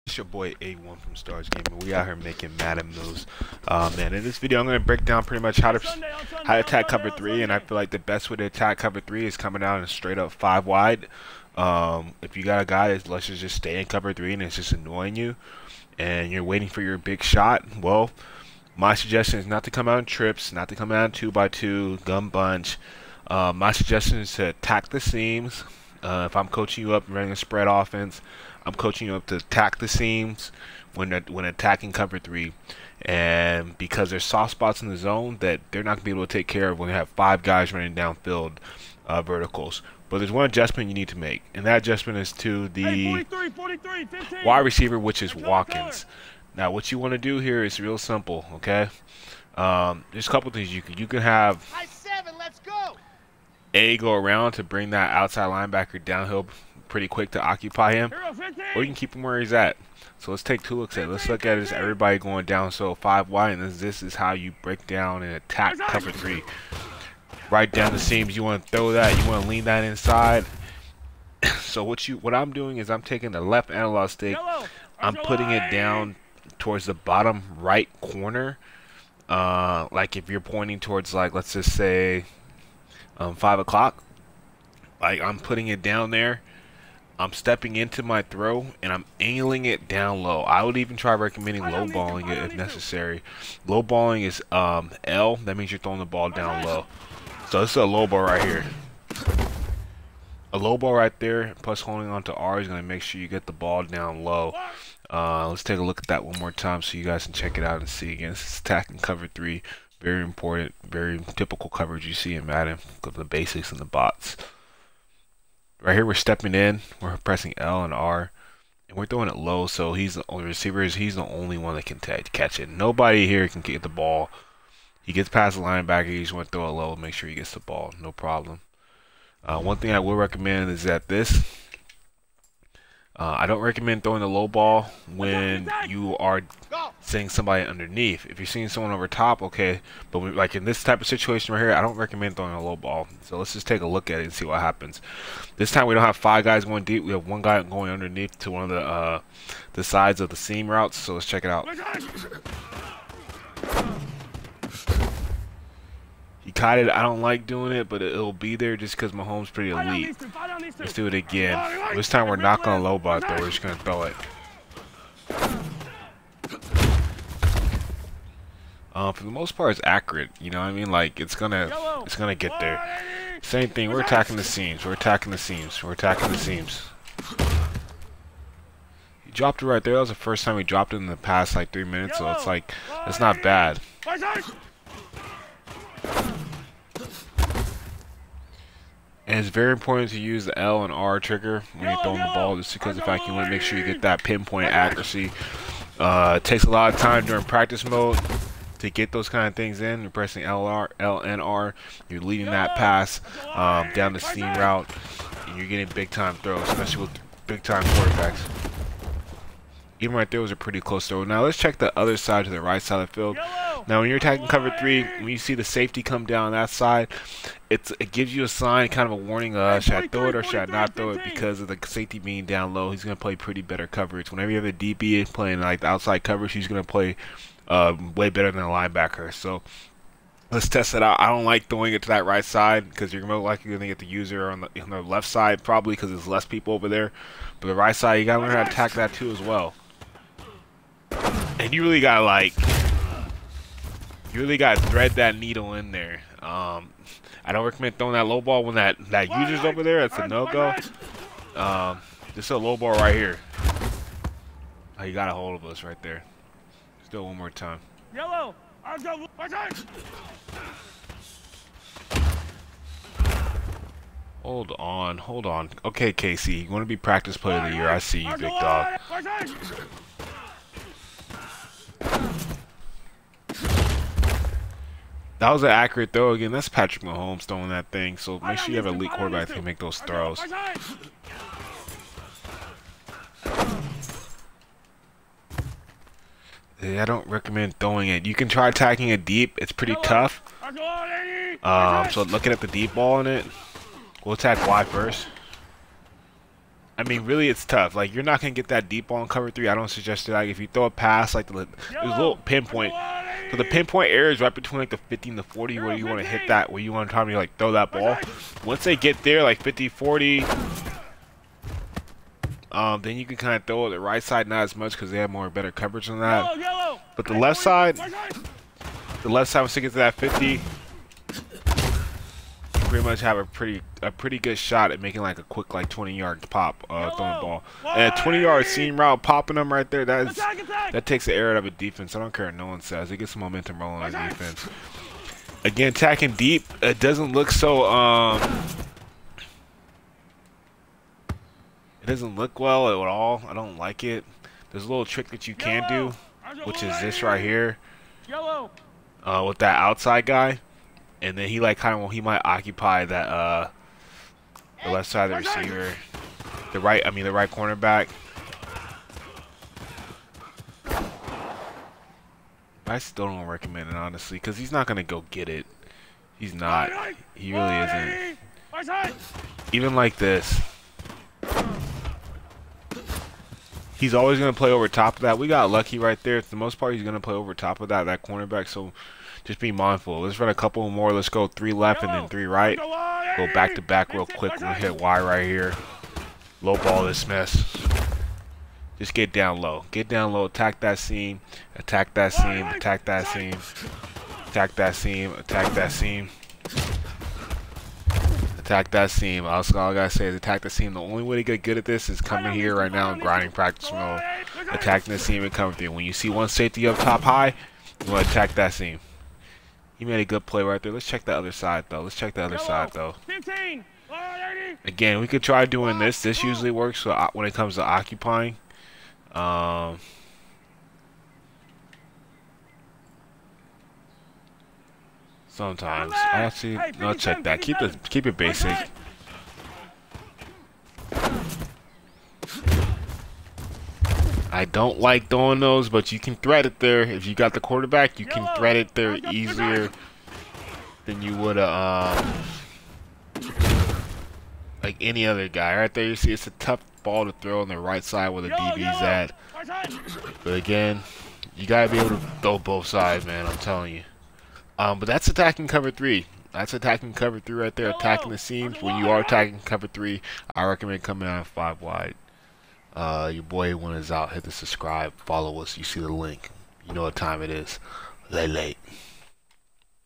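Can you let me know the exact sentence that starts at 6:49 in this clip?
He made a good play right there.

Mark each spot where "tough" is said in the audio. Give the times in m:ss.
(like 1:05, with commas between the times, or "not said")
4:50, 4:57, 7:26.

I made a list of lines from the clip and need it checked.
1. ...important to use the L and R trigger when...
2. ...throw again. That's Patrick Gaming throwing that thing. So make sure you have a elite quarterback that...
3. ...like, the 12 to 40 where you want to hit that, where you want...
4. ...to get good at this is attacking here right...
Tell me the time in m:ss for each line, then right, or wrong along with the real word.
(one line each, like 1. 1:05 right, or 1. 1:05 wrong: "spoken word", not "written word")
1. 3:09 right
2. 4:36 wrong: "Mahomes", not "Gaming"
3. 5:04 wrong: "15", not "12"
4. 6:41 wrong: "coming", not "attacking".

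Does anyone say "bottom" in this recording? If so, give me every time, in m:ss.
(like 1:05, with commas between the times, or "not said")
1:16.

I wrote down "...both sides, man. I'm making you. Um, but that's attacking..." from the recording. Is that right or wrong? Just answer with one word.
wrong.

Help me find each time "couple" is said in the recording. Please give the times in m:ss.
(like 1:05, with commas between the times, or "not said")
0:50, 6:20.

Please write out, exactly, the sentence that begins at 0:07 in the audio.
And I feel like the best way to attack cover three is coming out and straight up five wide.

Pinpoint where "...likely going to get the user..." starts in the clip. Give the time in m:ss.
3:53.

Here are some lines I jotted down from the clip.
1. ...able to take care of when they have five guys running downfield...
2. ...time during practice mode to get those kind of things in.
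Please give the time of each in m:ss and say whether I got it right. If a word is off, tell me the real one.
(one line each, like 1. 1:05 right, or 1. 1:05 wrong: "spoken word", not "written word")
1. 0:36 right
2. 3:16 right.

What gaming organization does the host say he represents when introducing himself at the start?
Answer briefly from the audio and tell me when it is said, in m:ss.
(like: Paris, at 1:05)
Stars Gaming, at 0:01.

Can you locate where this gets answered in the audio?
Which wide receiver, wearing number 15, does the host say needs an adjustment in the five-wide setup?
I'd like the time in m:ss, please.
0:45.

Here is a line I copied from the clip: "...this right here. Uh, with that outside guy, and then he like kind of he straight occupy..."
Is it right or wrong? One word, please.
wrong.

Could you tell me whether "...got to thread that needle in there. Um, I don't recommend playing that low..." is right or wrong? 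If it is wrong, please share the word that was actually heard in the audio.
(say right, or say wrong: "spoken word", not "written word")
wrong: "throwing", not "playing".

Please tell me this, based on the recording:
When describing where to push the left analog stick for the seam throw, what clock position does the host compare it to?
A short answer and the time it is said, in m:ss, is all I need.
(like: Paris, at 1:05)
five o'clock, at 1:23.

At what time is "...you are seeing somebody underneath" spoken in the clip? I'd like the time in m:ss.
2:15.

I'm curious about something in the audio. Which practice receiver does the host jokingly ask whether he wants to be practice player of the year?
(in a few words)
Casey.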